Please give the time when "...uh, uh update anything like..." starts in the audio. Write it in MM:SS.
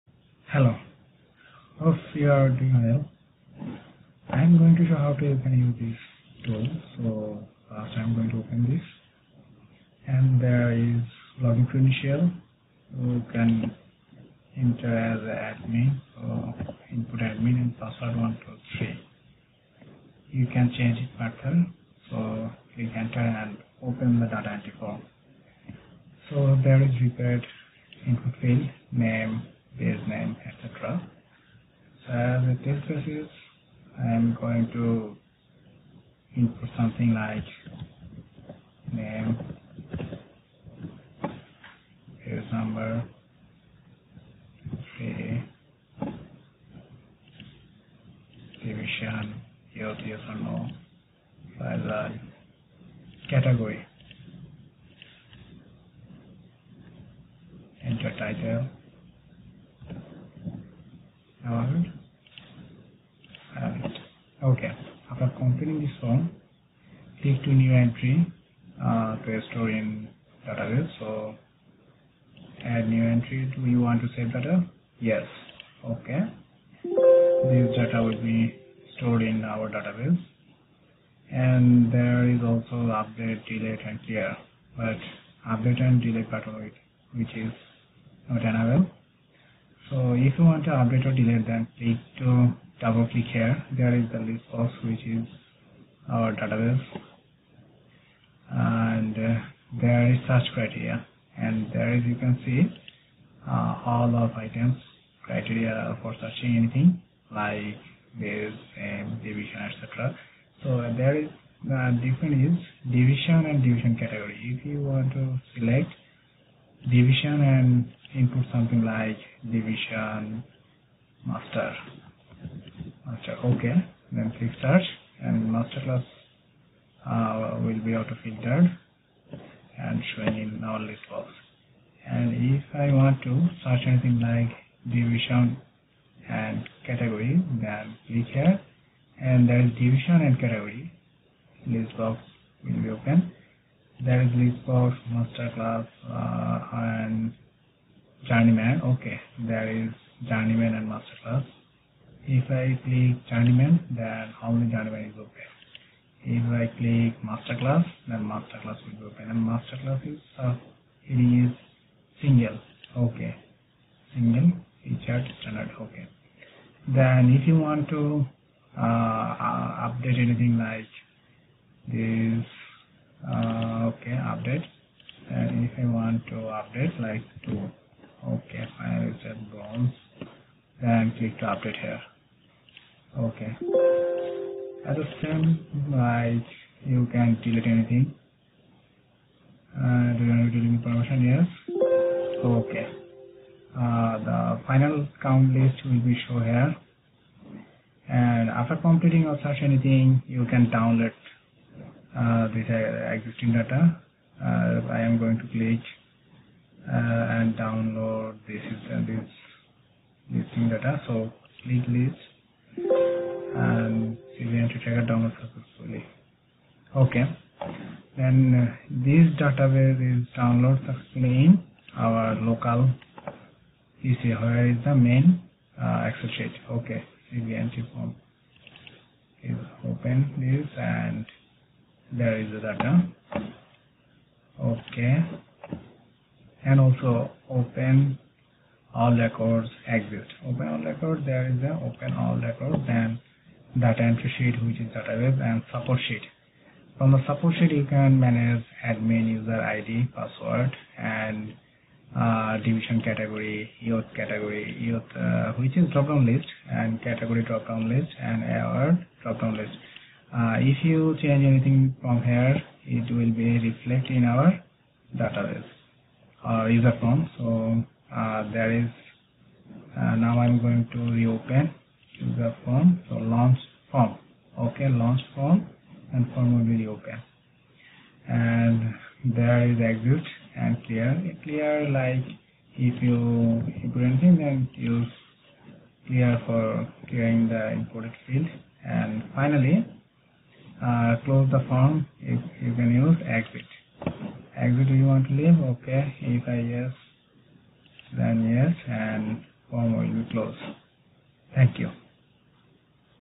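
02:48.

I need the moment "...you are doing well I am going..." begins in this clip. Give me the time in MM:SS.
00:02.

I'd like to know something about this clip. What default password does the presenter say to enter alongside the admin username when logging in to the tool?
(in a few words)
123.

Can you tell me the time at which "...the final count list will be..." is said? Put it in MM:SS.
03:14.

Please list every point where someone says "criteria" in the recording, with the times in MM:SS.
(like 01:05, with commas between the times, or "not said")
01:40, 01:45.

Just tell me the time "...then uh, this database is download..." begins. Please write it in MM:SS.
03:38.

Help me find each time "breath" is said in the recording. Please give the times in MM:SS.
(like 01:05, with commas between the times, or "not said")
not said.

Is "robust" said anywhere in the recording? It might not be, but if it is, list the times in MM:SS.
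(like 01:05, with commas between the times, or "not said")
not said.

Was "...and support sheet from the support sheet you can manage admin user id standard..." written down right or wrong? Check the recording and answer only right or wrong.
wrong.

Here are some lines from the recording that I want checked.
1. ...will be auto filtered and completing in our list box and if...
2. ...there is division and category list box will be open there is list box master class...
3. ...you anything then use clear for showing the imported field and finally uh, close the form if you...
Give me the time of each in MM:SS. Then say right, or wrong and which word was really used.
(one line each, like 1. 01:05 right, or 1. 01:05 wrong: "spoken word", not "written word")
1. 02:07 wrong: "showing", not "completing"
2. 02:19 right
3. 04:43 wrong: "clearing", not "showing".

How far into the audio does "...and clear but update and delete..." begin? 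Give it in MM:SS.
01:23.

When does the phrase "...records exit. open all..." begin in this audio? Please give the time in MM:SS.
03:59.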